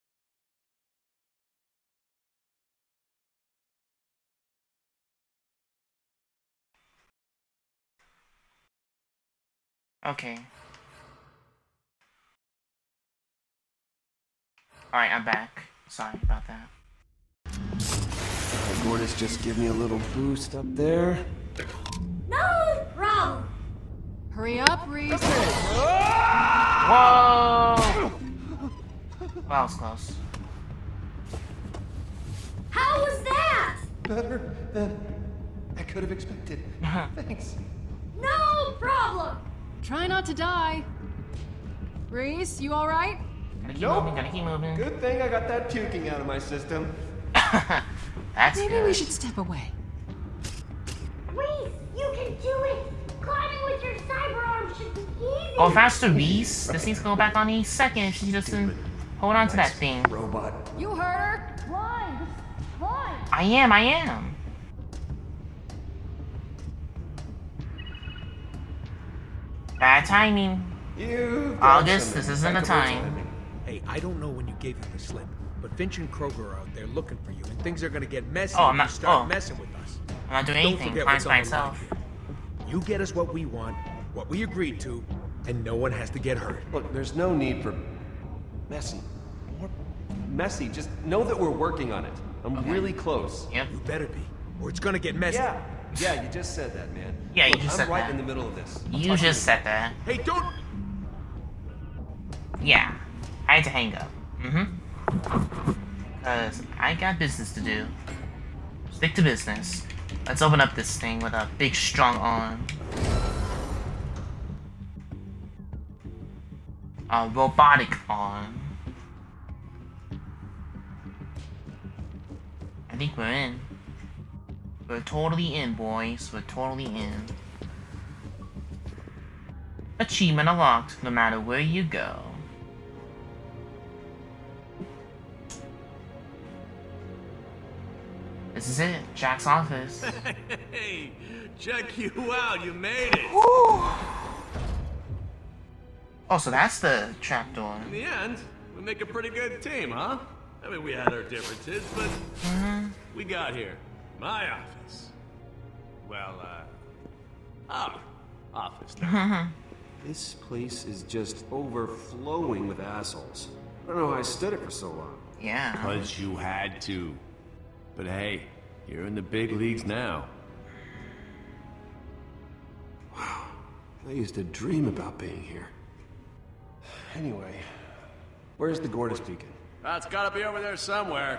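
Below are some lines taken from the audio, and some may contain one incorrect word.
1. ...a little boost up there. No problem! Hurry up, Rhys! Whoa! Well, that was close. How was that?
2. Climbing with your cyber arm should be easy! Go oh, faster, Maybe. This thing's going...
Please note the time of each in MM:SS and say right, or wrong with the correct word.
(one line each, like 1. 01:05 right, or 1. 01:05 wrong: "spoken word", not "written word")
1. 00:19 right
2. 00:53 wrong: "Rhys", not "Maybe".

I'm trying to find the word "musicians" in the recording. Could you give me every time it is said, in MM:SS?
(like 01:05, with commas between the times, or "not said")
not said.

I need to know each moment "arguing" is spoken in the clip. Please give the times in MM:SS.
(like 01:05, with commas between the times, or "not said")
not said.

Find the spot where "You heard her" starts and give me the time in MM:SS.
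01:00.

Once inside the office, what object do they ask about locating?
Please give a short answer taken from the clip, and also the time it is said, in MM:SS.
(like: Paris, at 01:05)
Gortys Beacon, at 02:58.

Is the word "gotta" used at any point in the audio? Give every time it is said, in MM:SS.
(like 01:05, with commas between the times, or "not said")
00:44, 03:00.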